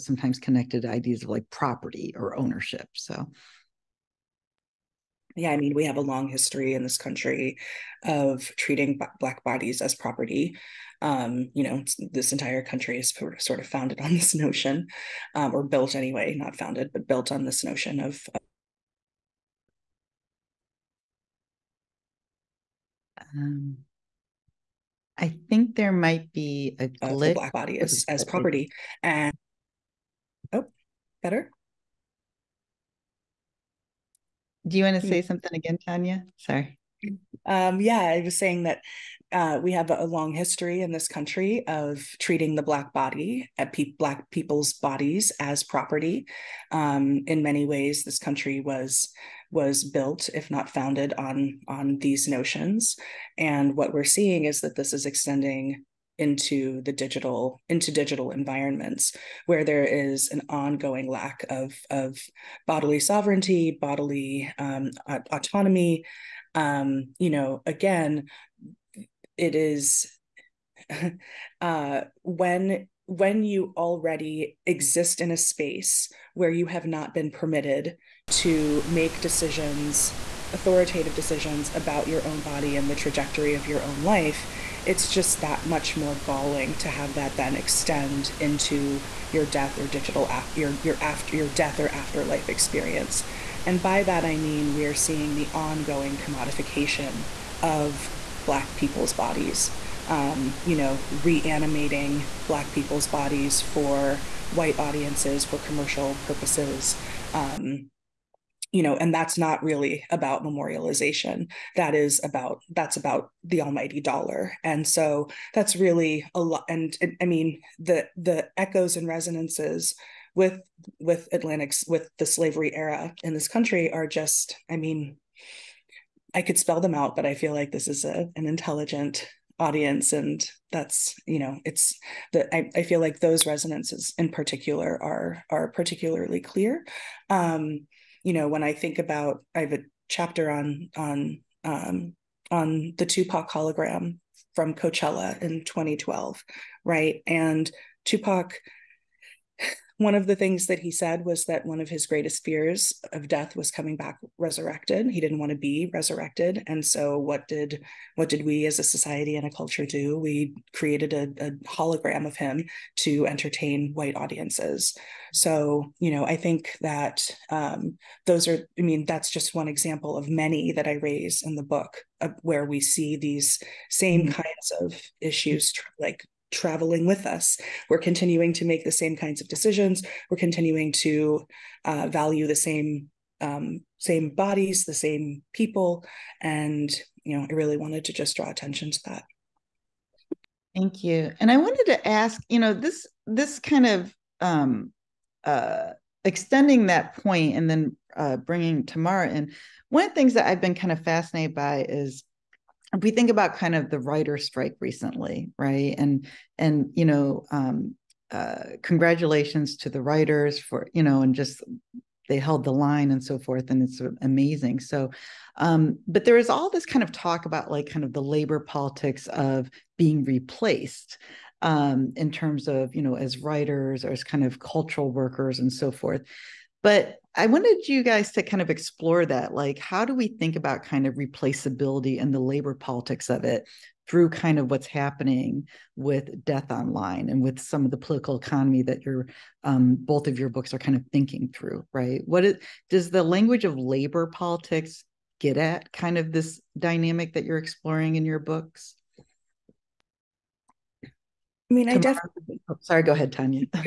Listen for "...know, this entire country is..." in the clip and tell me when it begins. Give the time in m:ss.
0:11.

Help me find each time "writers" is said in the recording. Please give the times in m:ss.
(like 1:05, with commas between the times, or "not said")
3:23, 3:30, 3:43.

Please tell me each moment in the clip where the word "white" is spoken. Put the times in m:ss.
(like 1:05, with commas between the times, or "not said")
1:44, 2:43.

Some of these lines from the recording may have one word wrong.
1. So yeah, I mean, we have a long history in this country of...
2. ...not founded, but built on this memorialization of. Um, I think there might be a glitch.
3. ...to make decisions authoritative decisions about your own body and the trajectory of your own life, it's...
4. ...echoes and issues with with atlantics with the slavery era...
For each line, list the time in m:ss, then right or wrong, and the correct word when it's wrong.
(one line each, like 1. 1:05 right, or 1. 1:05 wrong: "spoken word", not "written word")
1. 0:02 right
2. 0:16 wrong: "notion", not "memorialization"
3. 1:18 right
4. 1:58 wrong: "resonances", not "issues".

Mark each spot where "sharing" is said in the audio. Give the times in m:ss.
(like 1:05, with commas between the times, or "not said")
not said.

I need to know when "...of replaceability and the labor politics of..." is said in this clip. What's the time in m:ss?
3:51.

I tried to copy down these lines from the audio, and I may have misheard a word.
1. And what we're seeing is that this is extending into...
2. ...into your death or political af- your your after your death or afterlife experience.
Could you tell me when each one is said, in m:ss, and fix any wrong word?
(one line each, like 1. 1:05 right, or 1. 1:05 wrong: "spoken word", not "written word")
1. 0:53 right
2. 1:28 wrong: "digital", not "political".